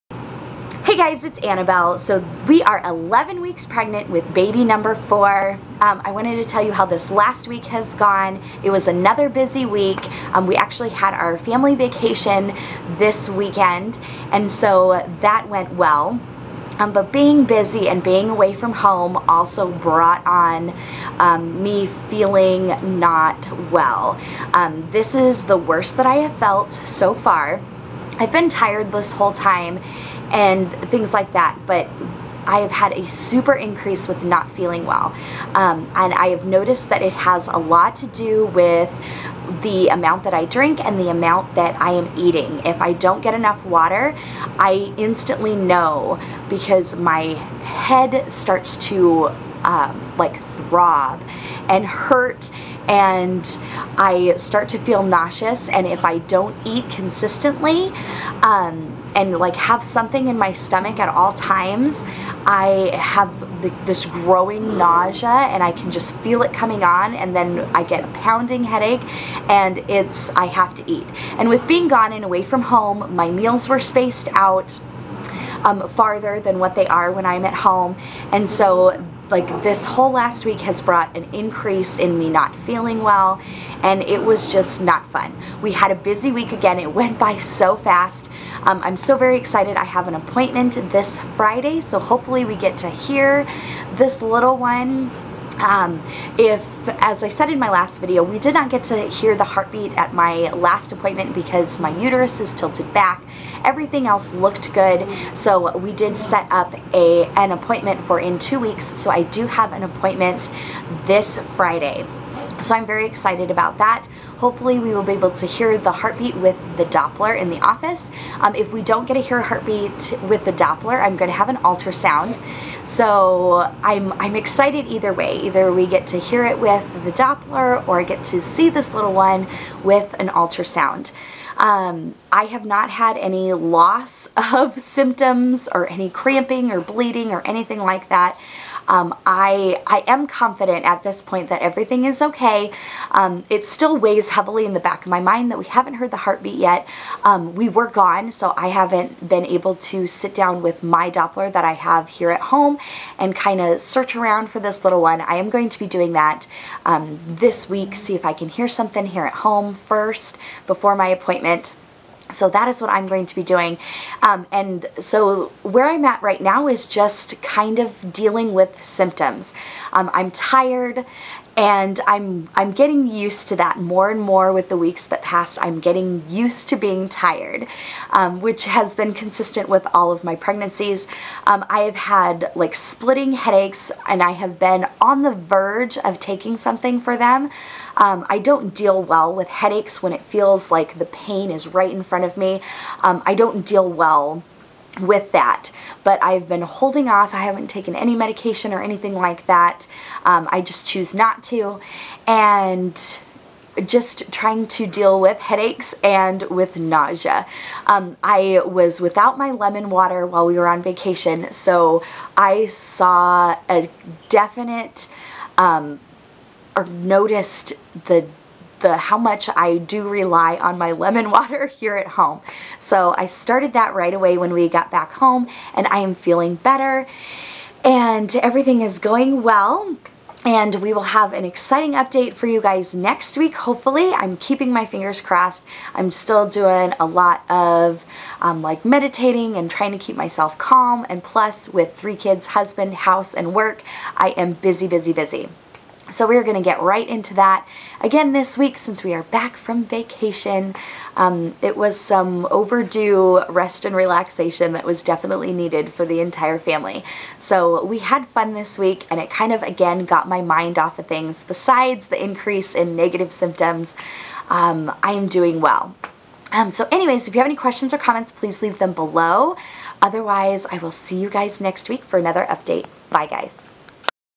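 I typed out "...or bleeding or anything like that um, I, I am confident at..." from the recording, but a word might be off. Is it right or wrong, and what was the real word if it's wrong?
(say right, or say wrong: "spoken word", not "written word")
right.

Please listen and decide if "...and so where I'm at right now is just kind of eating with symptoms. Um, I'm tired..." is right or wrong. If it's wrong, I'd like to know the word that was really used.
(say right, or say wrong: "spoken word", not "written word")
wrong: "dealing", not "eating".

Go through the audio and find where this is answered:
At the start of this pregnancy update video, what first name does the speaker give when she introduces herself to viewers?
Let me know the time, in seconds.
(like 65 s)
1 s.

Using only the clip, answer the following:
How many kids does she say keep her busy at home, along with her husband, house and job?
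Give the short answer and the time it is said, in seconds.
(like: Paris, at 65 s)
3, at 241 s.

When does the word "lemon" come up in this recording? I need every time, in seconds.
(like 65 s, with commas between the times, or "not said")
209 s, 220 s.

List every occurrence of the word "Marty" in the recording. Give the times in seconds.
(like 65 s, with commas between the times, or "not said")
not said.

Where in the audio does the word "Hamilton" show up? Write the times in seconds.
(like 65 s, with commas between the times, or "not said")
not said.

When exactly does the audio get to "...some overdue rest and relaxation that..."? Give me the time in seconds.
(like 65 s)
251 s.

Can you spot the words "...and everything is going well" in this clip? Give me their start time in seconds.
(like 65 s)
227 s.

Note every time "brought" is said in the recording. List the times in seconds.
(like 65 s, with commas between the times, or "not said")
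19 s, 80 s.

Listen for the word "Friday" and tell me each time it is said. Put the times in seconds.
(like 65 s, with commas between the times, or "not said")
91 s, 111 s.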